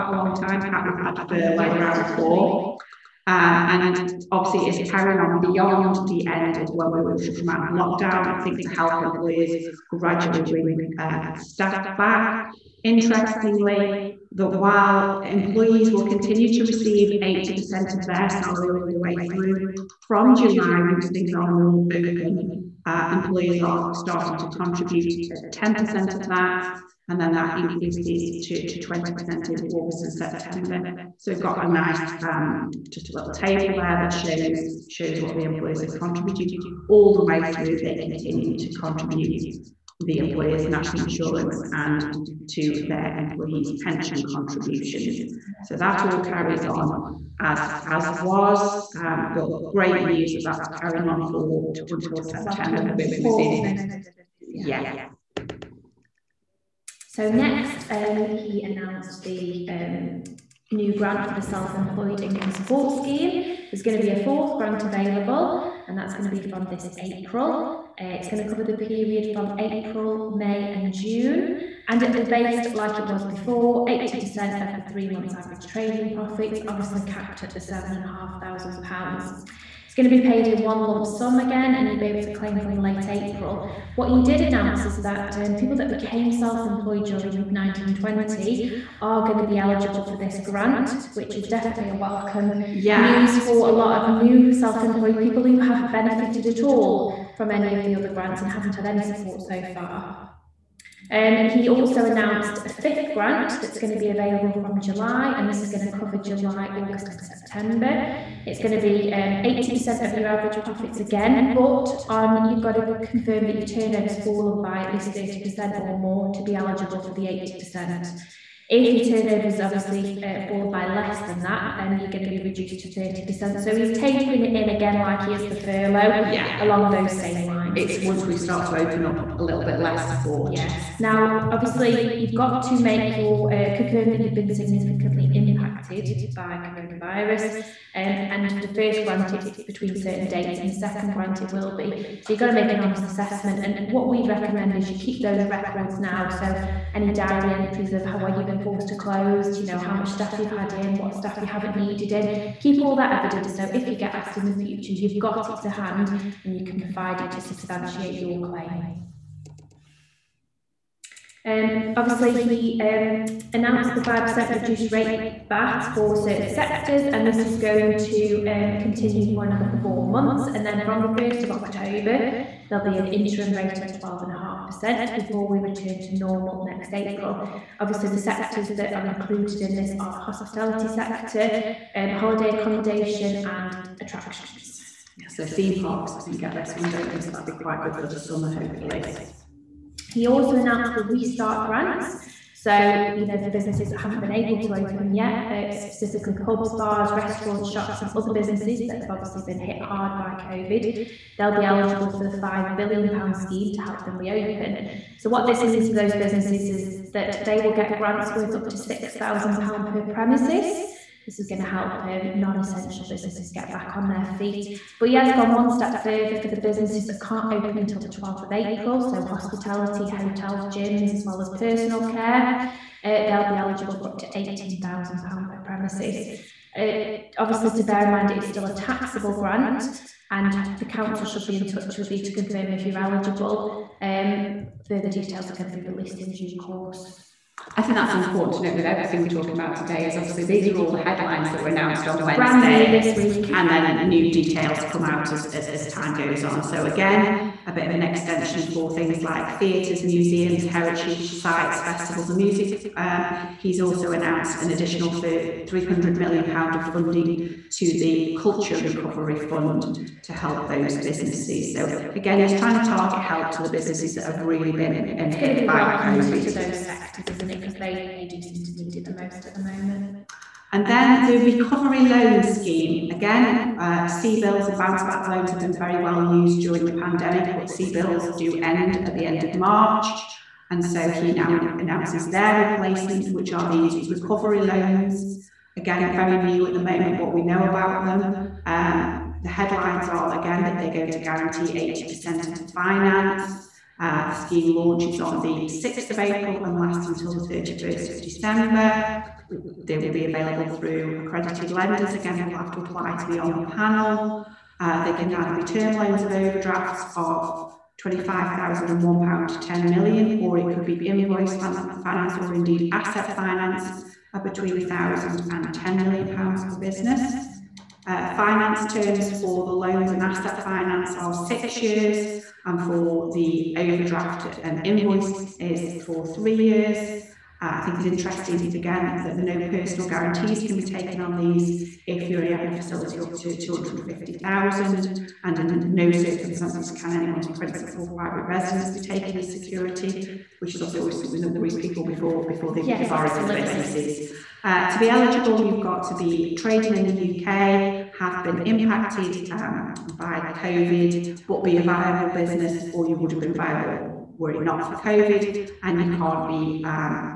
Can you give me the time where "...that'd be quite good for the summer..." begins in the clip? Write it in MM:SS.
03:07.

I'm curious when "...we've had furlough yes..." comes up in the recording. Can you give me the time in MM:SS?
00:00.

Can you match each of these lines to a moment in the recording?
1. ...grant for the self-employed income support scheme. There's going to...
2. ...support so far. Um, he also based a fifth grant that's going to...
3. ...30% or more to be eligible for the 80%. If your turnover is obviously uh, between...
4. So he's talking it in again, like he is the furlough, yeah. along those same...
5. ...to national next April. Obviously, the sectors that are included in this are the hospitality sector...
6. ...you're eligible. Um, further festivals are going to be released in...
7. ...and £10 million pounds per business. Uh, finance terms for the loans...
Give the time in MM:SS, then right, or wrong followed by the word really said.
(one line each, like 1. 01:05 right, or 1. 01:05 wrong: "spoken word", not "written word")
1. 01:00 right
2. 01:39 wrong: "announced", not "based"
3. 01:55 wrong: "fallen", not "between"
4. 02:03 wrong: "tapering", not "talking"
5. 02:56 wrong: "normal", not "national"
6. 03:52 wrong: "details", not "festivals"
7. 05:15 right.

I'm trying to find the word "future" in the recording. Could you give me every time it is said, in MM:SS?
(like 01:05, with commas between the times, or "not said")
02:34.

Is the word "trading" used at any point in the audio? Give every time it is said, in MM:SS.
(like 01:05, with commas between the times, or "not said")
01:15, 05:46.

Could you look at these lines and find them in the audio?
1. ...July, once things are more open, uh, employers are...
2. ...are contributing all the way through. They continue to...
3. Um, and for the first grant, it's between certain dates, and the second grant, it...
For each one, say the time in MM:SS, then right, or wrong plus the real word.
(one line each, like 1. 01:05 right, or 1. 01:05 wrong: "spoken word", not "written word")
1. 00:20 right
2. 00:35 right
3. 02:17 right.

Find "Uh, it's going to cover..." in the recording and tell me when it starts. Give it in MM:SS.
01:08.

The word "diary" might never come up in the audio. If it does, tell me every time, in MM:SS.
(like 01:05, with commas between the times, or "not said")
02:27.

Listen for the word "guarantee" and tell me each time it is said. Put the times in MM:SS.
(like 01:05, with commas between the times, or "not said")
04:51, 05:30.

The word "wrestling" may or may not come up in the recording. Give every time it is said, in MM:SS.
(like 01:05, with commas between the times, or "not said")
not said.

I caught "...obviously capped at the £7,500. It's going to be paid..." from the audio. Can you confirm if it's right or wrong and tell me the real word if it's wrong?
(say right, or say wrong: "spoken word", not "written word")
right.